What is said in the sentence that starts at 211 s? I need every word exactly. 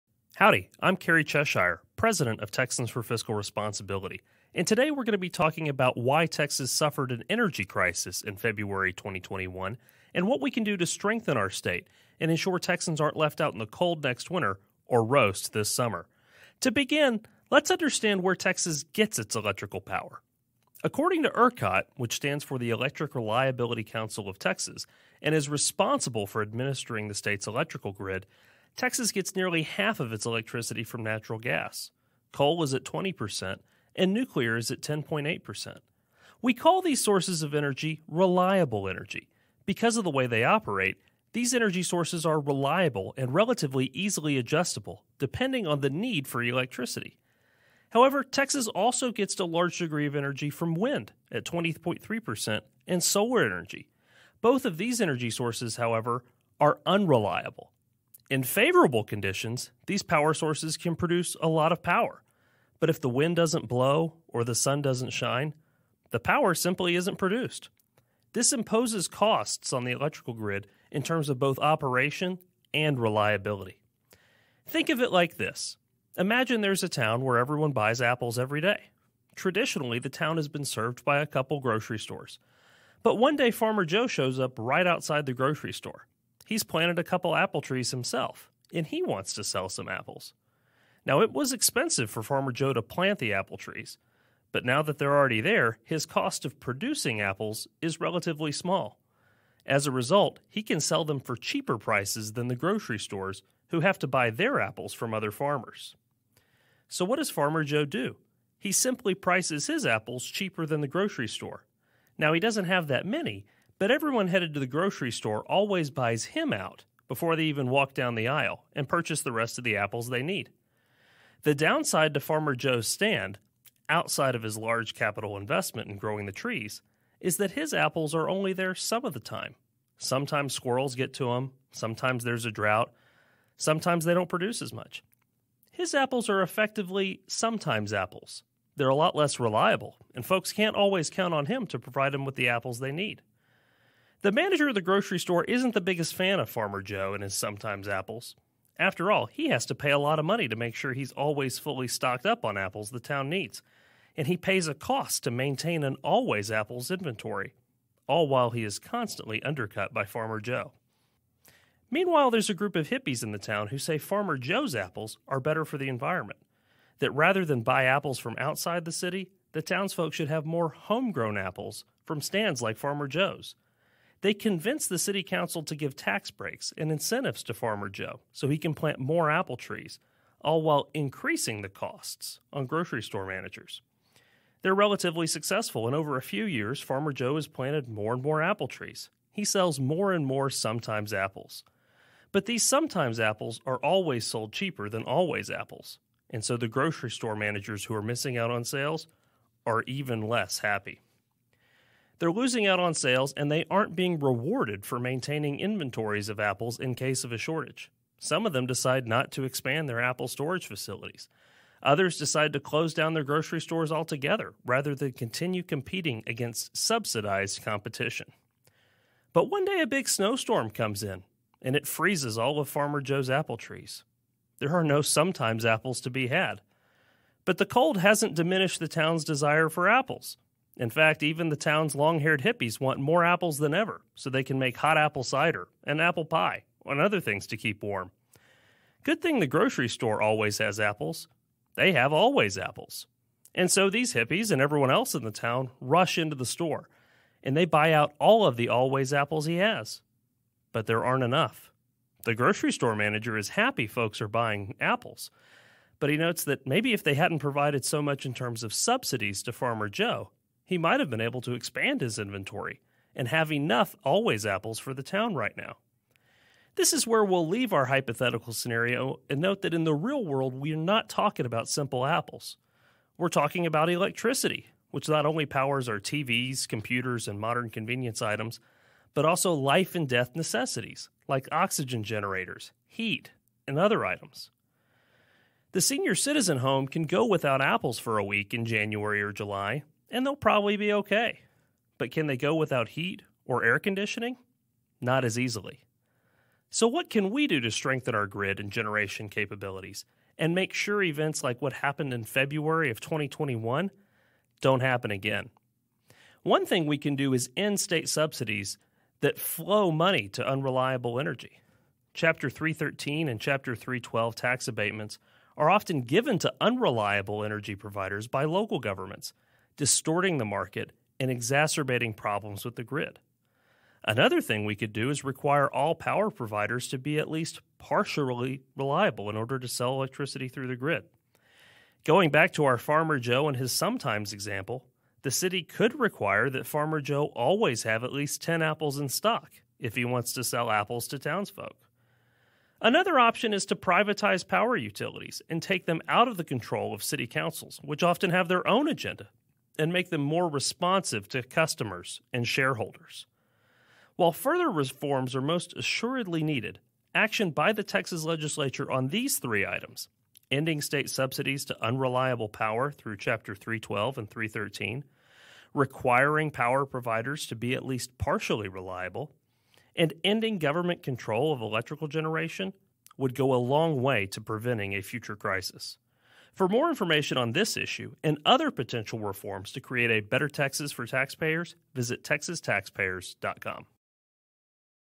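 Others decide to close down their grocery stores altogether rather than continue competing against subsidized competition.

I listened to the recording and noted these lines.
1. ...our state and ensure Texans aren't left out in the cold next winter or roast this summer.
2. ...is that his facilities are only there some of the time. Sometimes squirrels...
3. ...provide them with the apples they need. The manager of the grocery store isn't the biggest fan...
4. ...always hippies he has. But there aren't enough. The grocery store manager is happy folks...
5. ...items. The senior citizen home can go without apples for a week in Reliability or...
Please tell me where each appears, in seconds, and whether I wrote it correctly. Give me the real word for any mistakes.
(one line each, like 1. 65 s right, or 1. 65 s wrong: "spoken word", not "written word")
1. 11 s right
2. 127 s wrong: "apples", not "facilities"
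3. 141 s right
4. 248 s wrong: "apples", not "hippies"
5. 284 s wrong: "January", not "Reliability".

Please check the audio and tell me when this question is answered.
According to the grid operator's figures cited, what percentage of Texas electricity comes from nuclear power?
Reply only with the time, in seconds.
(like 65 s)
34 s.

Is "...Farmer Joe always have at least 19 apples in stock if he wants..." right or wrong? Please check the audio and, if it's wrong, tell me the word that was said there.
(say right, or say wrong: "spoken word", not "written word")
wrong: "10", not "19".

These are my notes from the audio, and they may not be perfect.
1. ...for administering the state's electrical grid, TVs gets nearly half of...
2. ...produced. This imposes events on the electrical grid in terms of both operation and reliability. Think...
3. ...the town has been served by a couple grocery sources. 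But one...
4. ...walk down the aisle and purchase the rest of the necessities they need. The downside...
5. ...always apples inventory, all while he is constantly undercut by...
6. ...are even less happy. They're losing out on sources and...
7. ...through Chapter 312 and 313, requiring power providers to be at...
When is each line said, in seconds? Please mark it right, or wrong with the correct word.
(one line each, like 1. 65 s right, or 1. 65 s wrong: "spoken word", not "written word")
1. 26 s wrong: "Texas", not "TVs"
2. 67 s wrong: "costs", not "events"
3. 79 s wrong: "stores", not "sources"
4. 117 s wrong: "apples", not "necessities"
5. 156 s right
6. 199 s wrong: "sales", not "sources"
7. 362 s right.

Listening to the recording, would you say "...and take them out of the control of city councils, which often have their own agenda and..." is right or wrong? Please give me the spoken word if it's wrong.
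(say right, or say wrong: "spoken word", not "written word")
right.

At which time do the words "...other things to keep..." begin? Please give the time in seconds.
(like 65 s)
236 s.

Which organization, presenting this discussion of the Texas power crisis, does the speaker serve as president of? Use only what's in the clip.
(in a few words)
Texans for Fiscal Responsibility.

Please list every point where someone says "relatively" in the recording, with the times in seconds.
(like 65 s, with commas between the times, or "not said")
43 s, 98 s, 184 s.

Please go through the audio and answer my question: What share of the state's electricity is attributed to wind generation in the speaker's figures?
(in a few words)
20.3%.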